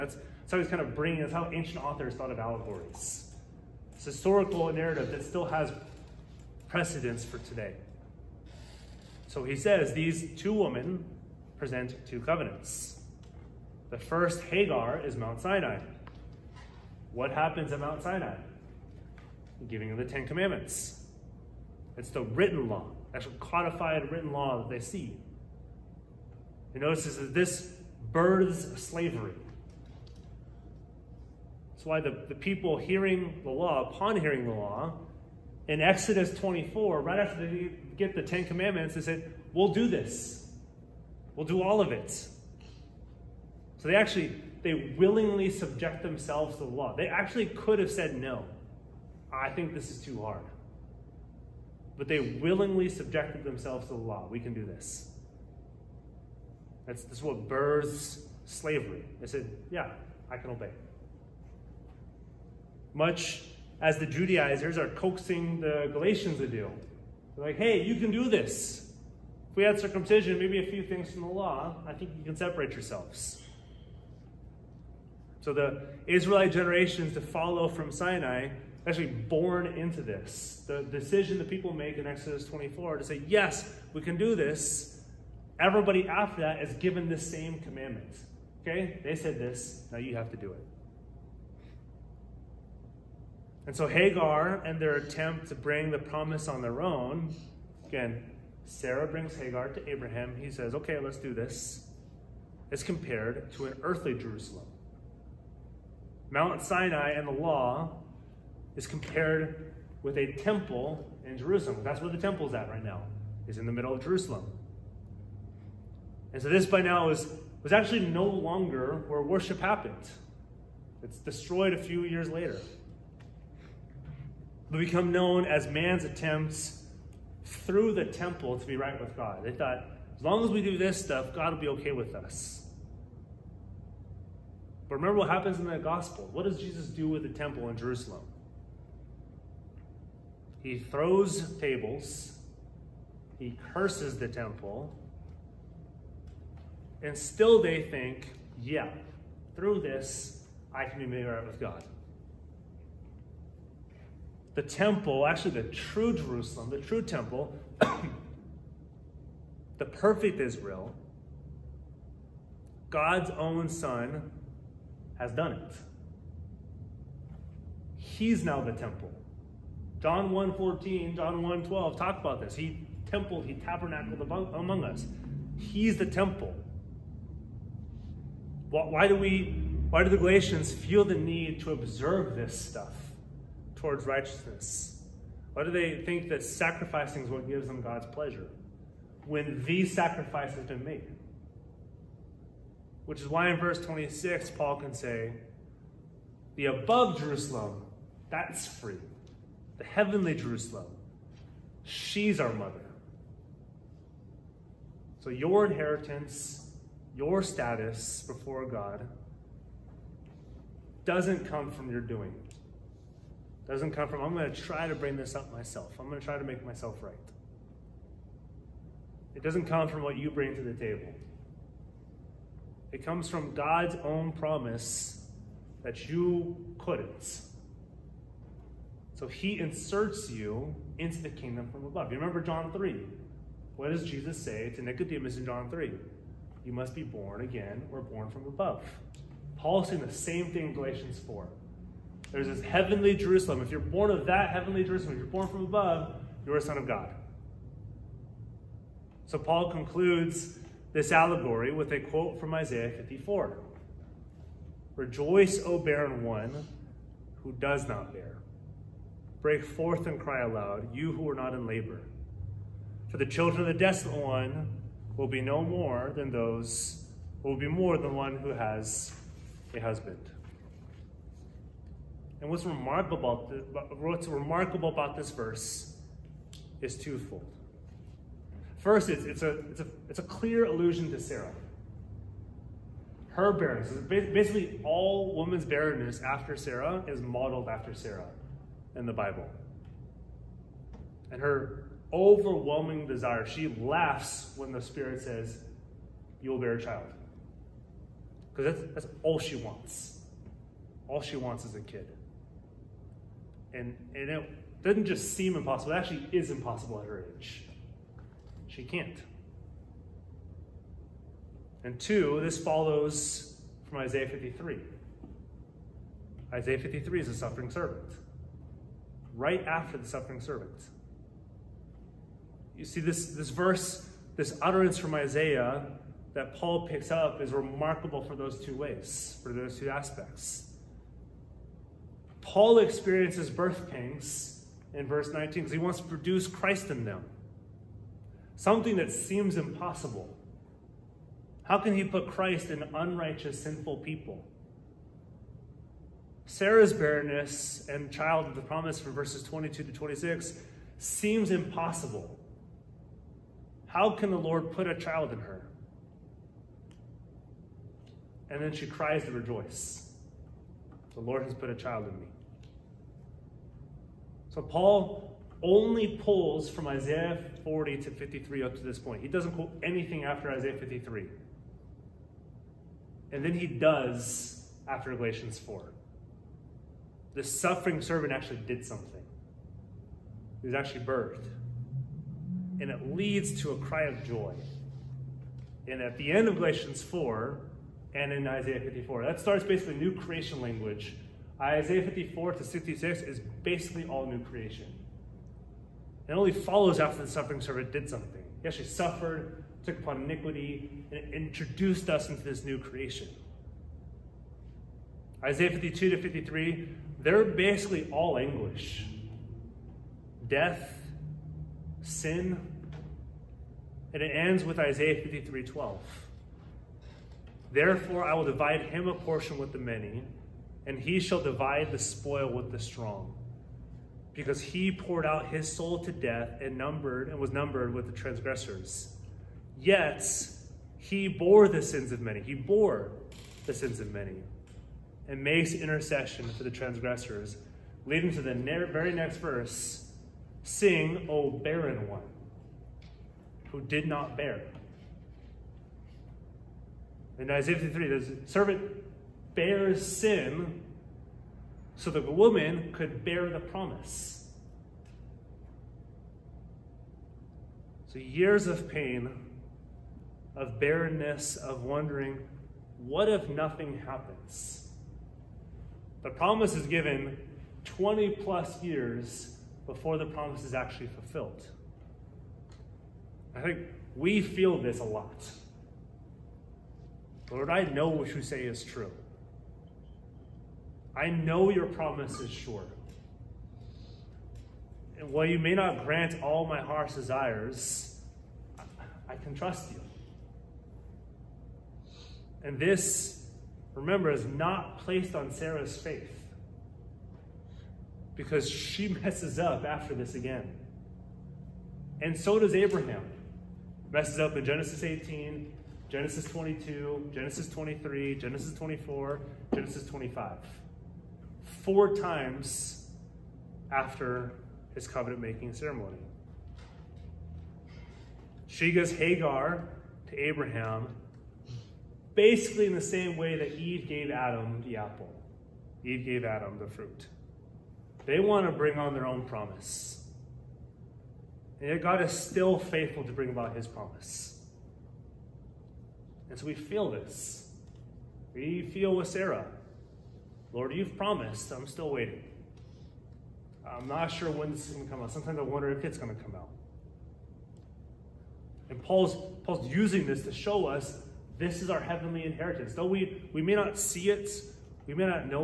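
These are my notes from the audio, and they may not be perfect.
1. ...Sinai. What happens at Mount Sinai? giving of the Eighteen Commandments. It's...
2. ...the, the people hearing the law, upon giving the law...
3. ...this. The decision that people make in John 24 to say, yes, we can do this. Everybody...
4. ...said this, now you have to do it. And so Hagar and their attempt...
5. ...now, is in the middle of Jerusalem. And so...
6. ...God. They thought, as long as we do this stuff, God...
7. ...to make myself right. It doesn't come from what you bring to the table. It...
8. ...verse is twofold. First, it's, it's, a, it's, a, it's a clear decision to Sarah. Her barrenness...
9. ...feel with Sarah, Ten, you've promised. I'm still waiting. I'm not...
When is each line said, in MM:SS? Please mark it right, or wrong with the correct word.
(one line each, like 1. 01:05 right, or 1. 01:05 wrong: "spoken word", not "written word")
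1. 00:15 wrong: "Ten", not "Eighteen"
2. 00:32 wrong: "hearing", not "giving"
3. 01:20 wrong: "Exodus", not "John"
4. 01:29 right
5. 01:52 right
6. 02:09 right
7. 03:36 right
8. 04:35 wrong: "allusion", not "decision"
9. 08:58 wrong: "Lord", not "Ten".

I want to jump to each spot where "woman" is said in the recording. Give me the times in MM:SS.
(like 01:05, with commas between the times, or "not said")
04:45, 07:32.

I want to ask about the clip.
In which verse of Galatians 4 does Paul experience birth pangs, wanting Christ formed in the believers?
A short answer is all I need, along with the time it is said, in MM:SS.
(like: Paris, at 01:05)
Verse 19, at 05:35.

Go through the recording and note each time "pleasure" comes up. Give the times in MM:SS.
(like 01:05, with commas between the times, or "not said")
03:08.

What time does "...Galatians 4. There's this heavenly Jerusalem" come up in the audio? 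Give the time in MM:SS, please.
04:00.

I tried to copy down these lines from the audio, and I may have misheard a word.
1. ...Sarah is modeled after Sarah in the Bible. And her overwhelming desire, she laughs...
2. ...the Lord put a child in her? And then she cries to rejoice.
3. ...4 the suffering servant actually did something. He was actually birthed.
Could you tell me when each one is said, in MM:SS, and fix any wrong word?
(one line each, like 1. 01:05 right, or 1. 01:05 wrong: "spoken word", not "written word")
1. 04:46 right
2. 05:54 right
3. 06:15 right.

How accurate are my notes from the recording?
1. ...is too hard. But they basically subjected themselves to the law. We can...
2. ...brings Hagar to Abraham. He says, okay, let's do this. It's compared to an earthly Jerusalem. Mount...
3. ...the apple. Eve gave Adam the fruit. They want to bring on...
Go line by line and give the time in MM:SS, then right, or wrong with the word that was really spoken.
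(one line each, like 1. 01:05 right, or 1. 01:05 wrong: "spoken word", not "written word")
1. 00:49 wrong: "willingly", not "basically"
2. 01:39 right
3. 08:44 right.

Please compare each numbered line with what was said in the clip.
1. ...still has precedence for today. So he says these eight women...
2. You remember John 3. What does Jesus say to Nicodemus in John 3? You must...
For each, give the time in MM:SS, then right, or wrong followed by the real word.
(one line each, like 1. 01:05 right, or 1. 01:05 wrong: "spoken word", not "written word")
1. 00:05 wrong: "two", not "eight"
2. 03:52 right.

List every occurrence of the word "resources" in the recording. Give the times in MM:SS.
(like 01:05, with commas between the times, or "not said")
not said.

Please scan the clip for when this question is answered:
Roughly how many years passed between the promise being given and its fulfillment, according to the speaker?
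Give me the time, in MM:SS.
07:47.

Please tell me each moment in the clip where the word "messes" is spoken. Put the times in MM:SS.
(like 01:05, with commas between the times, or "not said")
08:19, 08:24.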